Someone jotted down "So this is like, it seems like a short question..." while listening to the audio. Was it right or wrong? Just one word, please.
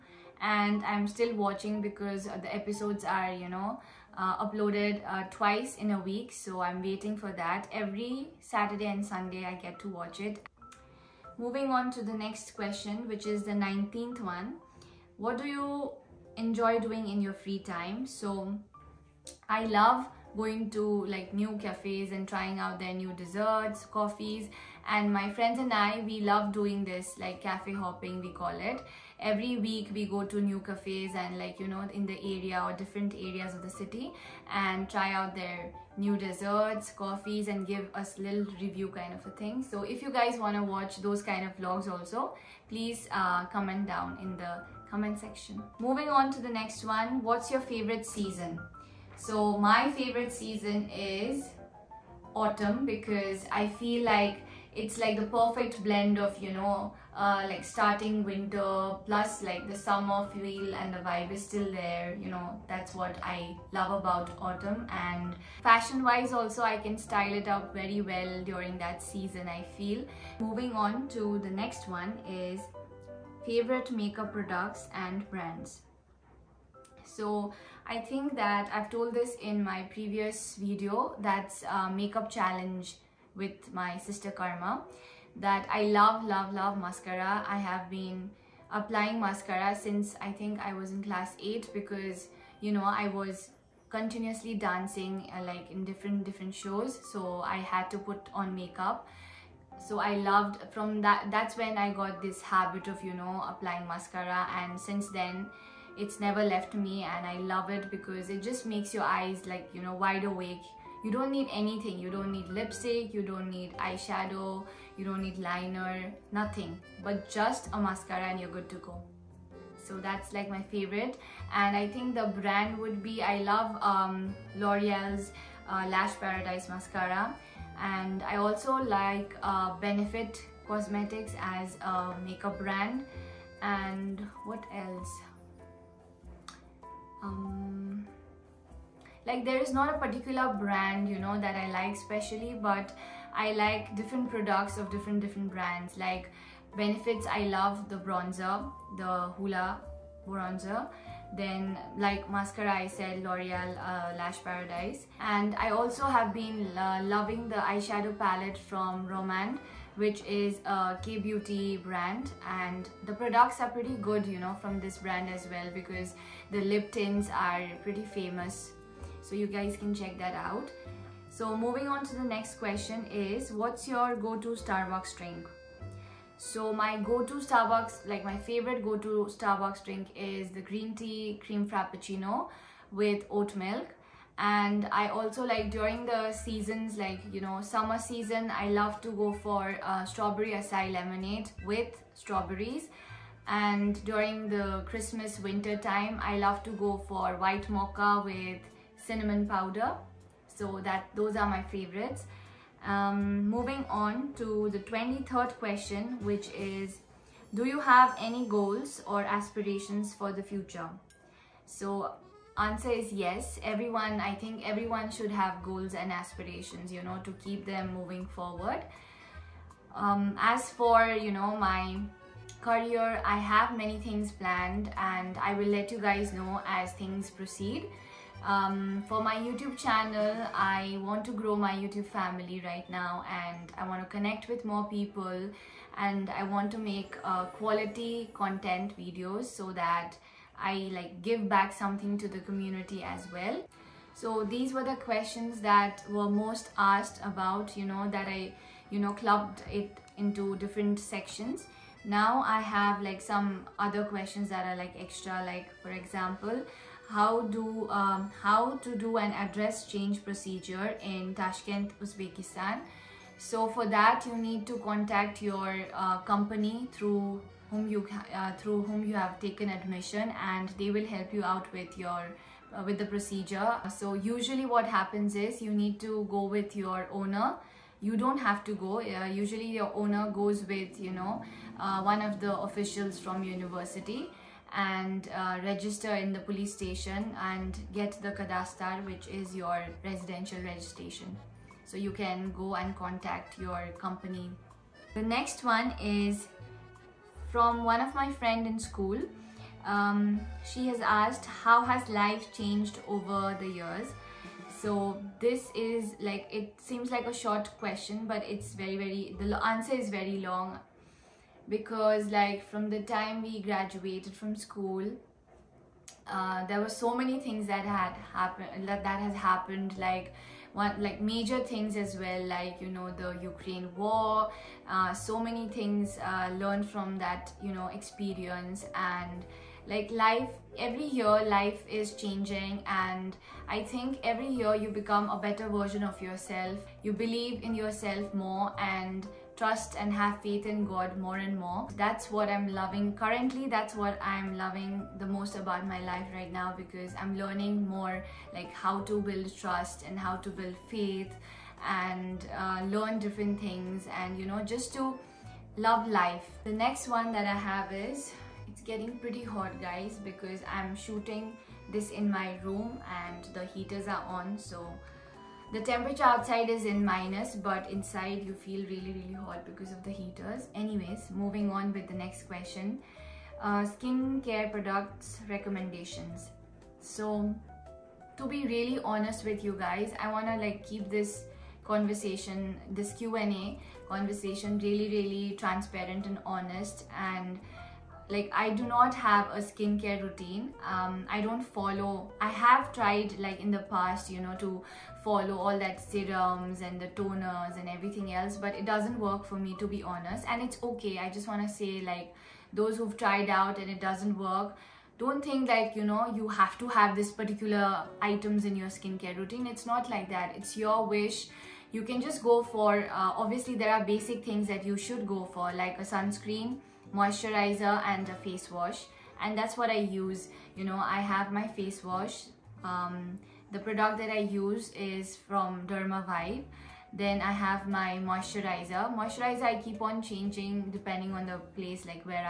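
right.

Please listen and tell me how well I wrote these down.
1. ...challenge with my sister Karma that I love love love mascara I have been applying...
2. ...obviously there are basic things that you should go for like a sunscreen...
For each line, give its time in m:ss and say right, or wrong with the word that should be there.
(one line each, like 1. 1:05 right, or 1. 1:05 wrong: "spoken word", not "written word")
1. 1:22 right
2. 6:53 right.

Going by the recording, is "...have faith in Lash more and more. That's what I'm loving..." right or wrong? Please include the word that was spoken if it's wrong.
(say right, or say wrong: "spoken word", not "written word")
wrong: "God", not "Lash".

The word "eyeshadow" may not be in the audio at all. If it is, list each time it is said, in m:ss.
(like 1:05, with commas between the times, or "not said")
1:53, 2:37.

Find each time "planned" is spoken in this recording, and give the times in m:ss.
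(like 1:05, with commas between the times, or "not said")
3:44.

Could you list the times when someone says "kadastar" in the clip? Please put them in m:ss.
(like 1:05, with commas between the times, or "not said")
4:48.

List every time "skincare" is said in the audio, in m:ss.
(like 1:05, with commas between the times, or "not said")
6:13, 6:29, 6:48.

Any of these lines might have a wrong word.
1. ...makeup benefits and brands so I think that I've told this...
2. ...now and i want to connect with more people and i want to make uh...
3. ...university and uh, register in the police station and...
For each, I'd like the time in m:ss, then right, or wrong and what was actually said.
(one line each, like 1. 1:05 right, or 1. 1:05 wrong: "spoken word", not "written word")
1. 1:13 wrong: "products", not "benefits"
2. 3:52 right
3. 4:43 right.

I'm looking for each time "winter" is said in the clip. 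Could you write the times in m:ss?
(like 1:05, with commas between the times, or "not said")
0:58, 3:15.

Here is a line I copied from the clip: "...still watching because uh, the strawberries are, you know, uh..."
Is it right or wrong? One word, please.
wrong.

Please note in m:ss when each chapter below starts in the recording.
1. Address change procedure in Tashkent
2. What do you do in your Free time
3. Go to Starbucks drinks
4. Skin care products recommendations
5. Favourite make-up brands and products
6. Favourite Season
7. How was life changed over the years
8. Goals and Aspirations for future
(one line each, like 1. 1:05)
1. 4:16
2. 0:12
3. 2:51
4. 6:14
5. 1:14
6. 0:46
7. 4:56
8. 3:24.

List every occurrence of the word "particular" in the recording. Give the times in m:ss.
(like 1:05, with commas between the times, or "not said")
2:19, 6:47.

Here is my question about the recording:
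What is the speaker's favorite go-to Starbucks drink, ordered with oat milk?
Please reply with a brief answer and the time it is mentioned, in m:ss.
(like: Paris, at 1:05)
green tea cream frappuccino, at 3:00.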